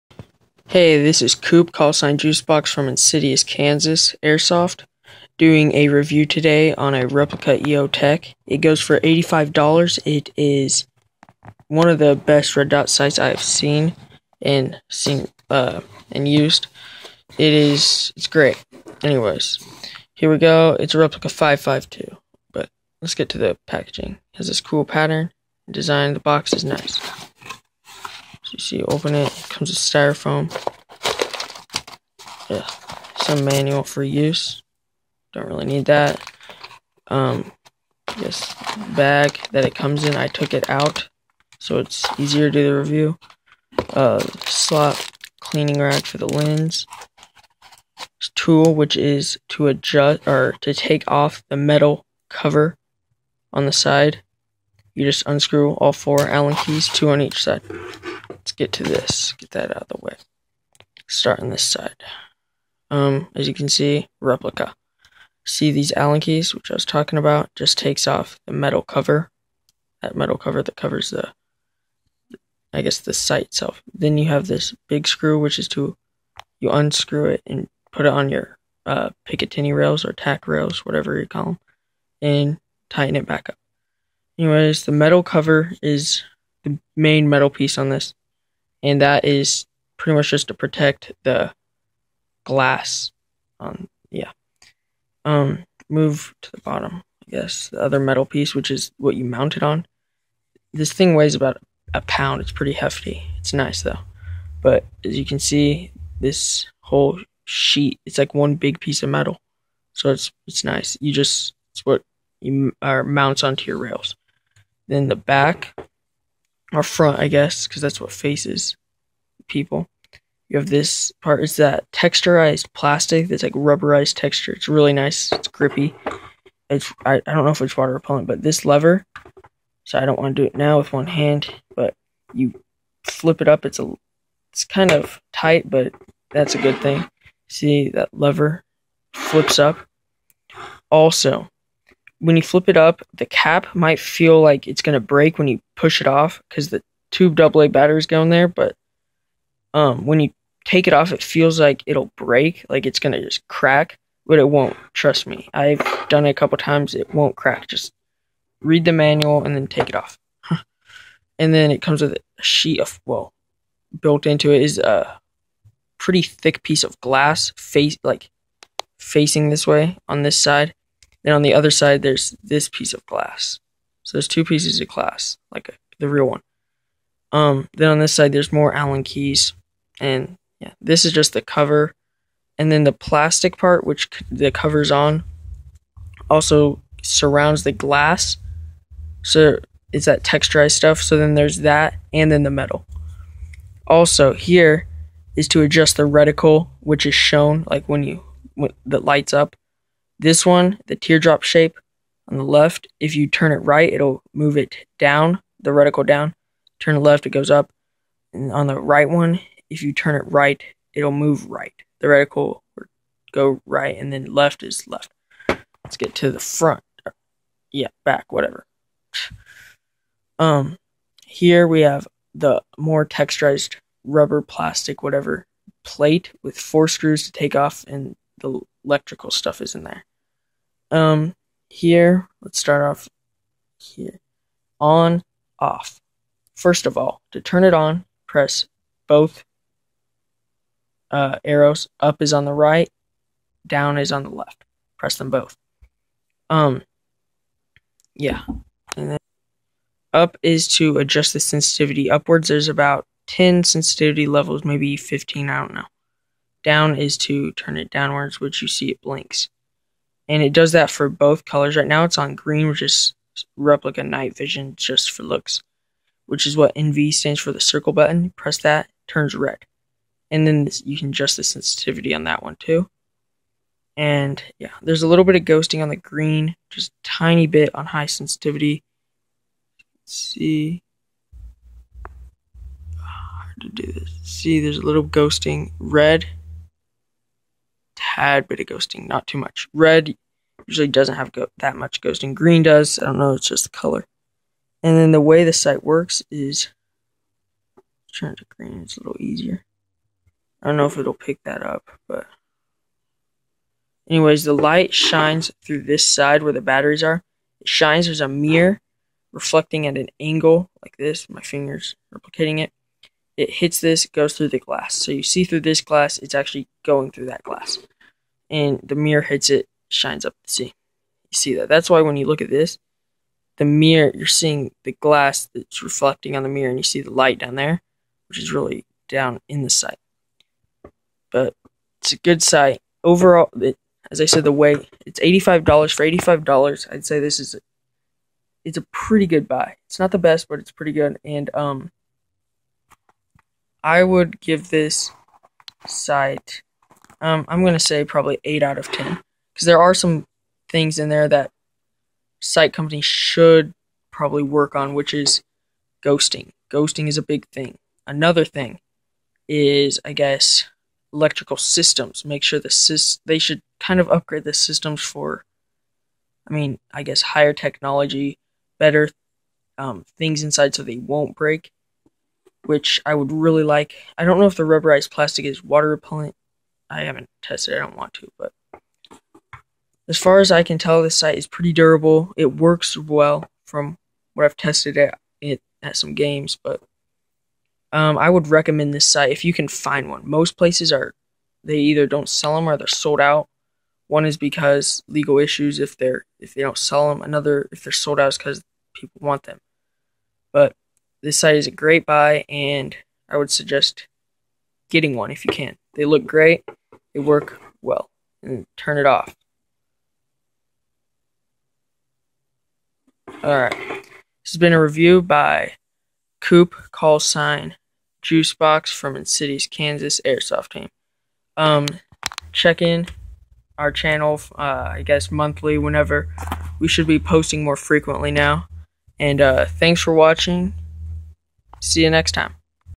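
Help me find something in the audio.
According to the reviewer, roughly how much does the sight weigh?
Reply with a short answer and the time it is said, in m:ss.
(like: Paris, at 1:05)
about a pound, at 1:41.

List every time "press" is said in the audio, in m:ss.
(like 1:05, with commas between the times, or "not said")
3:58, 4:04, 4:28.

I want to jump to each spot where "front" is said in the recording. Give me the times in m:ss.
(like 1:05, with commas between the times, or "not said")
1:56, 3:36.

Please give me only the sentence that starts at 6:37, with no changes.
Another if they're sold out is because people want them.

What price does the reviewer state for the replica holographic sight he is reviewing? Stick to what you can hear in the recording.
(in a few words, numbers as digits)
$85.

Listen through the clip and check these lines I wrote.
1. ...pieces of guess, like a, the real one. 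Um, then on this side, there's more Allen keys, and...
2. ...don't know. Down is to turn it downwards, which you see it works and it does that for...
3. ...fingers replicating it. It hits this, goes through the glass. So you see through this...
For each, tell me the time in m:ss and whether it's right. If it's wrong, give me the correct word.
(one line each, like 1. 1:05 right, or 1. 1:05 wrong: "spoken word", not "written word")
1. 2:54 wrong: "glass", not "guess"
2. 4:15 wrong: "blinks", not "works"
3. 5:11 right.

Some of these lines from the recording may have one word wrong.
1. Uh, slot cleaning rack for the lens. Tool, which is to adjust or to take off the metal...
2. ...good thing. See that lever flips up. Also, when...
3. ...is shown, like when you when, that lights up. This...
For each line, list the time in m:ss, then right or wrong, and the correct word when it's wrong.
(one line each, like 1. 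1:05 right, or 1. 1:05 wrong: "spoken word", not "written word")
1. 0:43 right
2. 2:16 right
3. 3:17 right.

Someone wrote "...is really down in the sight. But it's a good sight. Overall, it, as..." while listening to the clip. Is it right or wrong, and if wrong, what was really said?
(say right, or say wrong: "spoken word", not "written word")
right.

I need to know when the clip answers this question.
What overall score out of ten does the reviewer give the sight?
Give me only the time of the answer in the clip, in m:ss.
5:48.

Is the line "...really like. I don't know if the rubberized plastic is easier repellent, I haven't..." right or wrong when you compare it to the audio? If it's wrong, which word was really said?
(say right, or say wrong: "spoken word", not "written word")
wrong: "water", not "easier".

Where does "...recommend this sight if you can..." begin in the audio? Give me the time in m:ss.
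6:28.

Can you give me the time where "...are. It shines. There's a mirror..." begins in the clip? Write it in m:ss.
5:07.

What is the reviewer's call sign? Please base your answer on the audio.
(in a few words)
Juicebox.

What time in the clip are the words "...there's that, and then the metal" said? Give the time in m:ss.
3:11.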